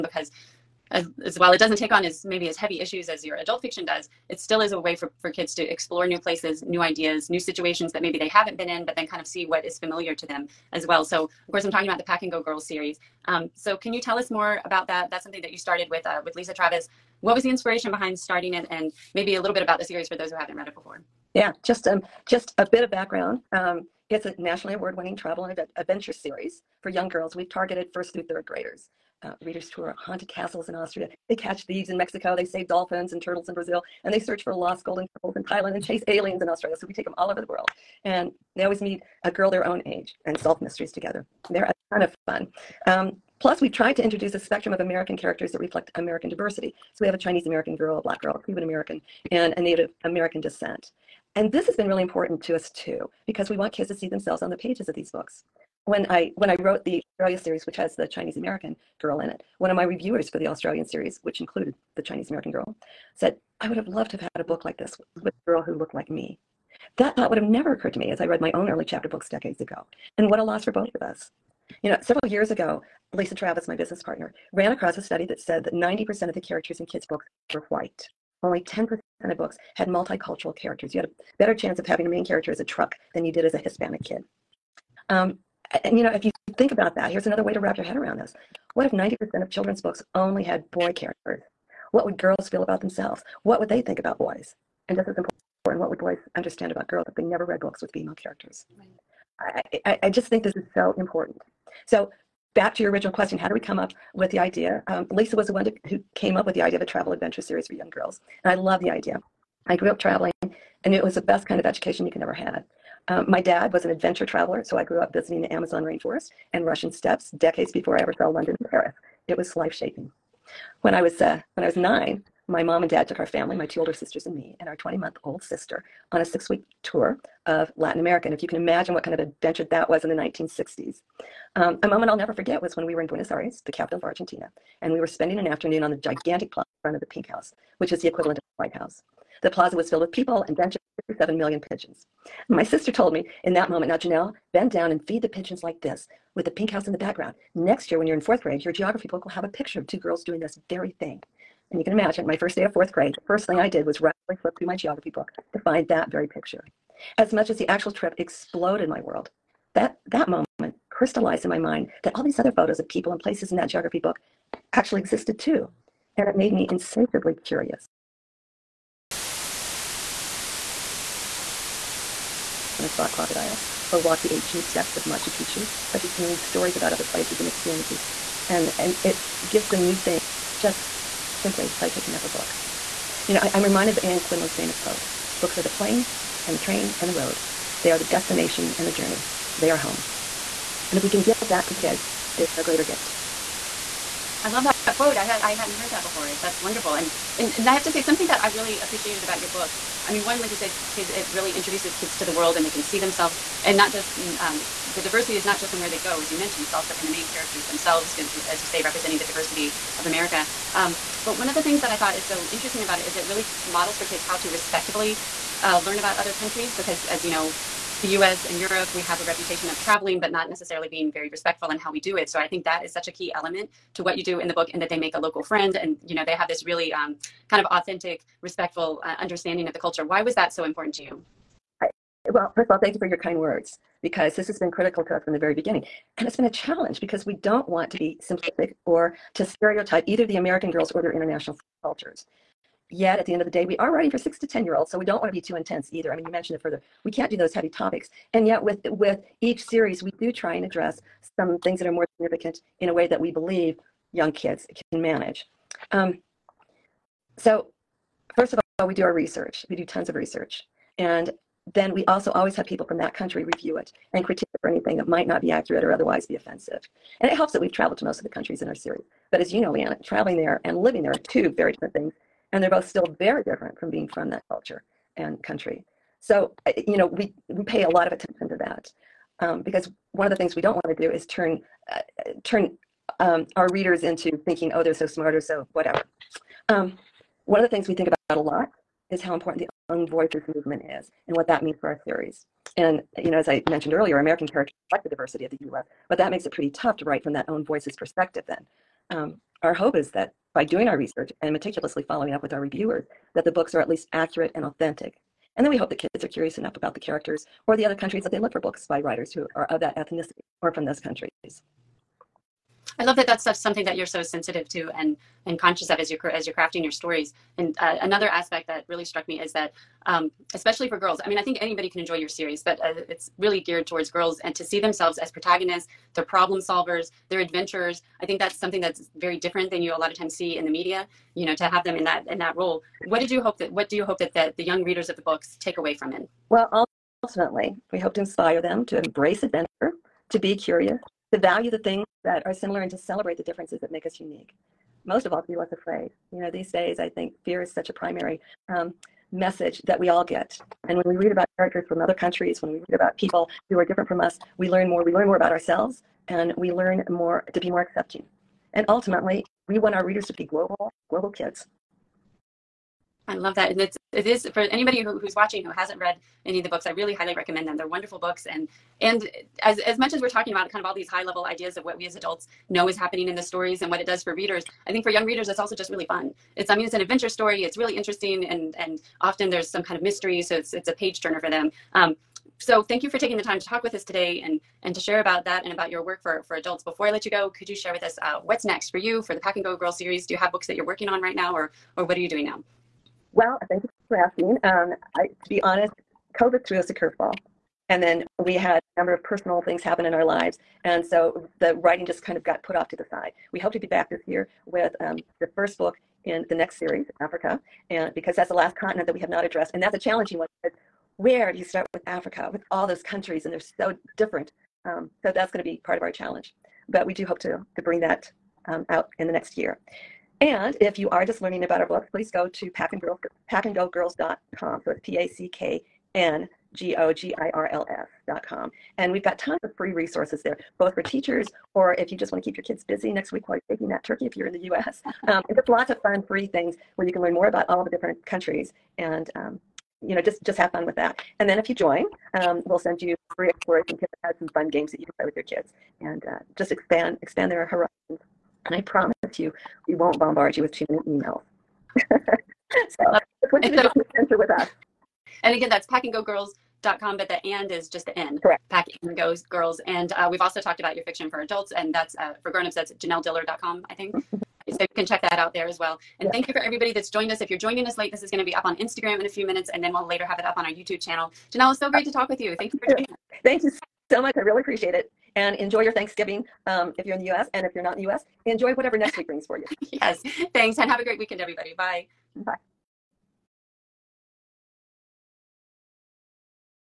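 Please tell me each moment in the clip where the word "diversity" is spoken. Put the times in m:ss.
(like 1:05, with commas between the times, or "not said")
0:46, 3:25, 3:29, 4:55.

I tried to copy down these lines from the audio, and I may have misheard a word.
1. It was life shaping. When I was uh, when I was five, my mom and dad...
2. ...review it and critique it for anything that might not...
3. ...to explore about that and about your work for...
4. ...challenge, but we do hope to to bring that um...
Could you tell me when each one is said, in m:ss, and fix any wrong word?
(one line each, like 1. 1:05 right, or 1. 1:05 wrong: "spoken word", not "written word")
1. 1:59 wrong: "nine", not "five"
2. 4:23 right
3. 6:24 wrong: "share", not "explore"
4. 6:56 right.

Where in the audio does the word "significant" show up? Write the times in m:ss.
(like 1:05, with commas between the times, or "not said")
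4:12.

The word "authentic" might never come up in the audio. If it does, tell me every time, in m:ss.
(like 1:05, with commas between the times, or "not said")
3:47, 5:04.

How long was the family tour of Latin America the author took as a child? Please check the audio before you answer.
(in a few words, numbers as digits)
6 weeks.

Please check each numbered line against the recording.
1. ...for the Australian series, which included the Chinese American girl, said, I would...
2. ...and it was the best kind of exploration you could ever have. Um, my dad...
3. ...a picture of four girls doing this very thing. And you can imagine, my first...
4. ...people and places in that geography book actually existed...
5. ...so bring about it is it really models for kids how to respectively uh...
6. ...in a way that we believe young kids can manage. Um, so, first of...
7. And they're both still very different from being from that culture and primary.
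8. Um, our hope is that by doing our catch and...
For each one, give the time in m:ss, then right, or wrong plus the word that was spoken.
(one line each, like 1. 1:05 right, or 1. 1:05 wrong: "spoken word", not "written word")
1. 1:00 right
2. 1:50 wrong: "education", not "exploration"
3. 2:29 wrong: "two", not "four"
4. 2:42 right
5. 3:32 wrong: "interesting", not "bring"
6. 4:12 right
7. 4:32 wrong: "country", not "primary"
8. 4:59 wrong: "research", not "catch".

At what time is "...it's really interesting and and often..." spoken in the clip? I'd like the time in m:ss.
6:17.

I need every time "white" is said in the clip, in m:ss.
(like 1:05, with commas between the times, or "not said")
1:17, 2:18.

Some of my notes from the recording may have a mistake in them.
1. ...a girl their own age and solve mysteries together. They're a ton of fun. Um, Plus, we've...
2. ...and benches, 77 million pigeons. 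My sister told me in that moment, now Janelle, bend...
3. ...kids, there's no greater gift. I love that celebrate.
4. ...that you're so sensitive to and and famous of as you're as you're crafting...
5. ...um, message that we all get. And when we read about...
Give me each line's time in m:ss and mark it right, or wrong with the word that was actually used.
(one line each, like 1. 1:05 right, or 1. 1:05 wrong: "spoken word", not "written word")
1. 0:39 right
2. 2:20 wrong: "57", not "77"
3. 3:11 wrong: "quote", not "celebrate"
4. 5:13 wrong: "conscious", not "famous"
5. 5:48 right.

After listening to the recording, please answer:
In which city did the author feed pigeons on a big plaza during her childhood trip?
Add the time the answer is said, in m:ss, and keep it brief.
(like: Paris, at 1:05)
Buenos Aires, at 2:13.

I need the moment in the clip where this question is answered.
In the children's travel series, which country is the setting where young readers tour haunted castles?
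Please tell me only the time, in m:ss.
0:30.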